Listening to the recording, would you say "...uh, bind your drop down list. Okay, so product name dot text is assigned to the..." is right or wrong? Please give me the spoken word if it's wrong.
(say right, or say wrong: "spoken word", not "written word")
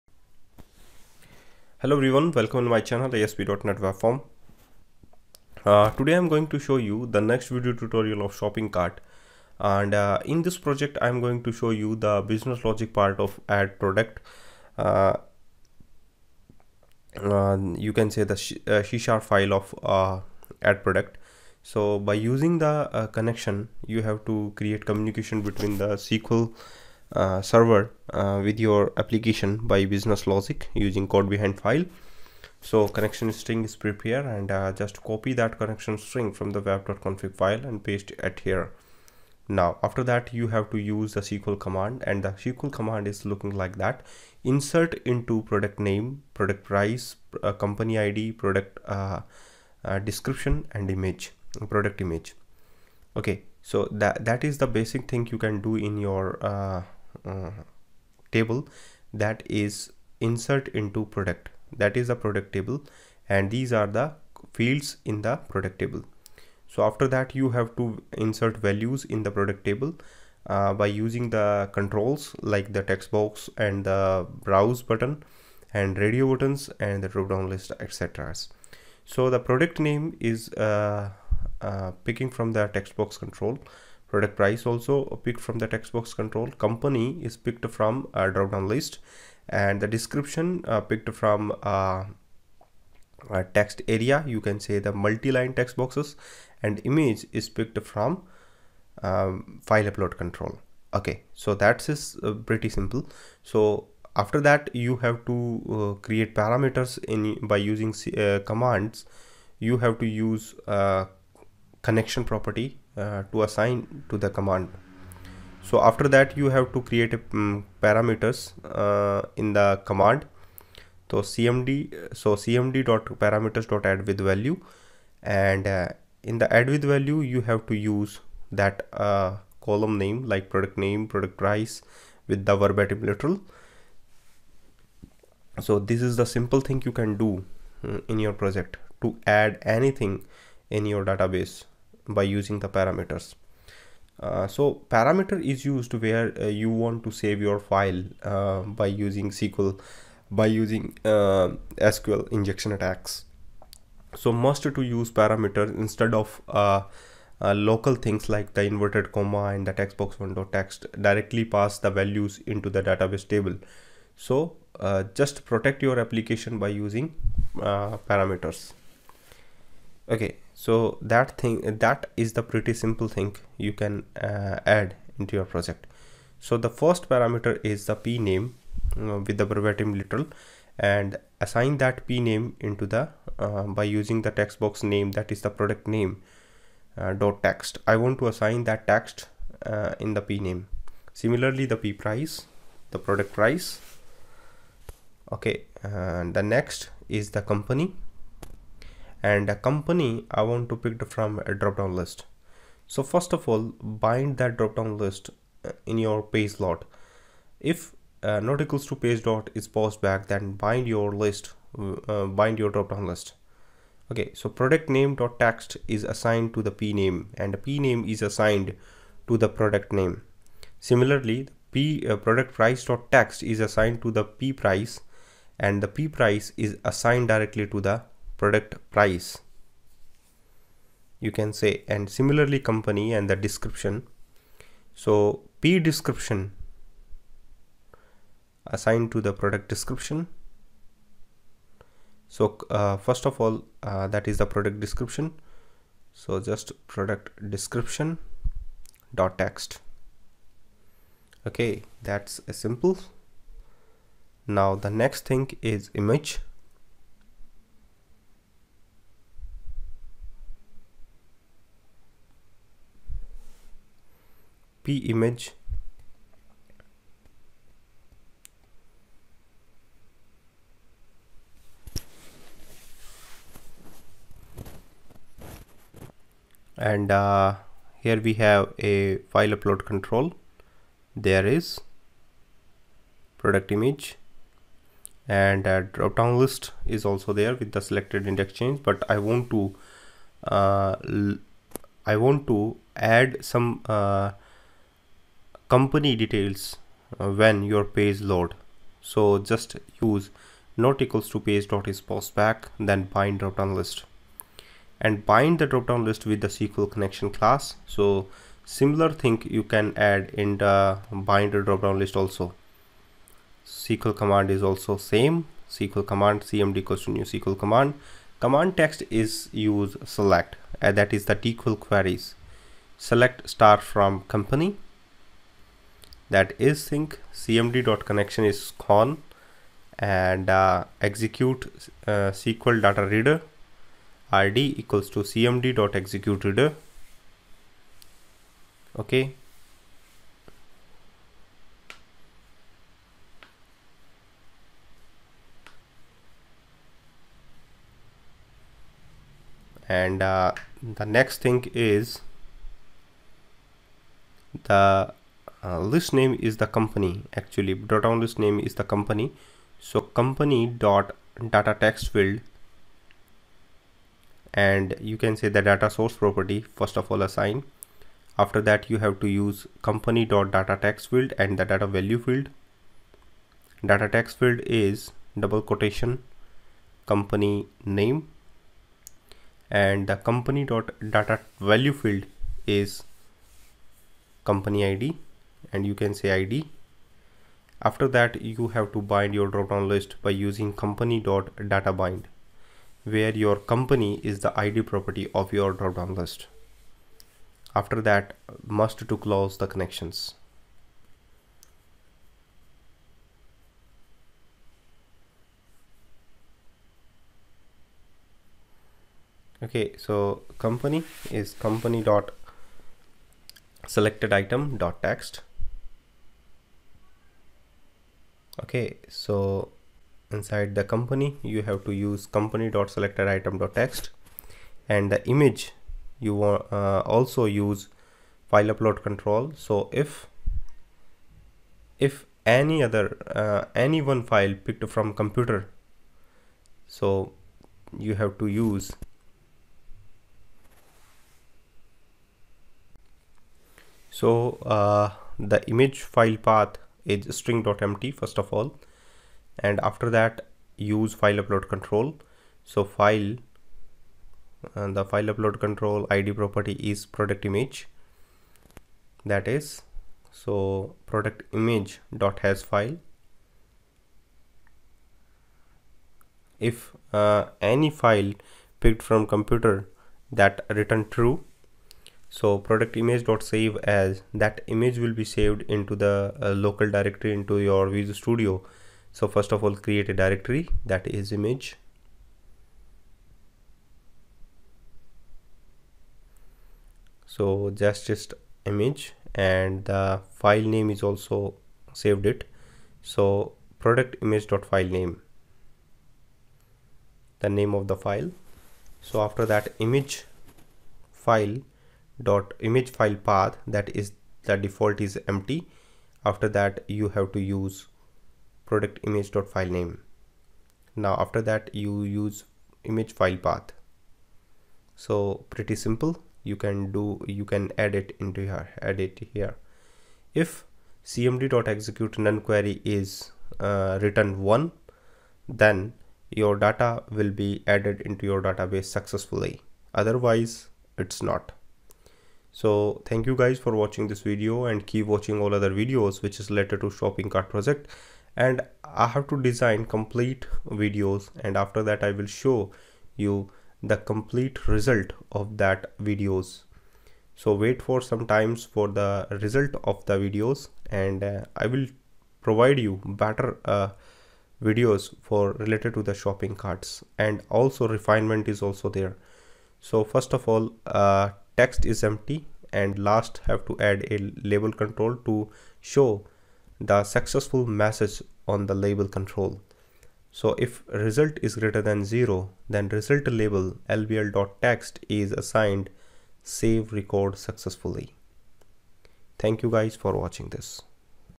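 right.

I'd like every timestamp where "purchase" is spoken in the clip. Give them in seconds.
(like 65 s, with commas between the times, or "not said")
not said.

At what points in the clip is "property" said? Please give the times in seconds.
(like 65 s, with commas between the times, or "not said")
112 s, 366 s, 394 s, 456 s.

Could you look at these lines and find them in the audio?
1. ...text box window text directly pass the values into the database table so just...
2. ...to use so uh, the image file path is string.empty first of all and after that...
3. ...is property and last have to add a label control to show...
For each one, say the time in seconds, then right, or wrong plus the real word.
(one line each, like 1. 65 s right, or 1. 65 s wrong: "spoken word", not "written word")
1. 159 s right
2. 438 s right
3. 561 s wrong: "empty", not "property".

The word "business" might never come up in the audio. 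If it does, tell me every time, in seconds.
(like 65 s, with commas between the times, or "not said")
12 s, 29 s.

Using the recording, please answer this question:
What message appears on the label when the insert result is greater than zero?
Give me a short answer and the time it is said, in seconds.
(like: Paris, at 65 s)
save record successfully, at 576 s.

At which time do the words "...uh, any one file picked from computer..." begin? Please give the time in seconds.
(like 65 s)
433 s.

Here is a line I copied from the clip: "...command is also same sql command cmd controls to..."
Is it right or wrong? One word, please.
wrong.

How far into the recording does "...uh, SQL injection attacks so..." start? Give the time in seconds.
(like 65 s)
151 s.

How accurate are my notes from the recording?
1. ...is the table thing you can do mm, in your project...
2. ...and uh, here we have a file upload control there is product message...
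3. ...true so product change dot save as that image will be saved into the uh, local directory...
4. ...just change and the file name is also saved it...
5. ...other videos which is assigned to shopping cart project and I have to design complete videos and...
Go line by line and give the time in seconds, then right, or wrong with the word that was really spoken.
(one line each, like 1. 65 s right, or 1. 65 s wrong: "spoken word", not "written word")
1. 136 s wrong: "simple", not "table"
2. 276 s wrong: "image", not "message"
3. 471 s wrong: "image", not "change"
4. 488 s wrong: "image", not "change"
5. 535 s wrong: "related", not "assigned".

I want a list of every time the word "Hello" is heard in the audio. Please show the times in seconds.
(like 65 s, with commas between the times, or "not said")
1 s.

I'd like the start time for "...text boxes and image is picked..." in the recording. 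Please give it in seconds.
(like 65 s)
95 s.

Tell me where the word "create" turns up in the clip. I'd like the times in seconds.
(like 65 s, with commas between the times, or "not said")
24 s, 106 s, 116 s, 479 s.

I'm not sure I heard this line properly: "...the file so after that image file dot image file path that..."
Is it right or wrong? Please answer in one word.
right.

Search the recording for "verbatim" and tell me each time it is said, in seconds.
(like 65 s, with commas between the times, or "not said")
132 s, 179 s.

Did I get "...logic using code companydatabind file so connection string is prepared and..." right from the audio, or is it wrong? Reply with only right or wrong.
wrong.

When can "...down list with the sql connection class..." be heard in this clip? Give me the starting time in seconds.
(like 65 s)
305 s.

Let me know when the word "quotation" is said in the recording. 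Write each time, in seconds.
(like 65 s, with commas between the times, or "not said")
375 s.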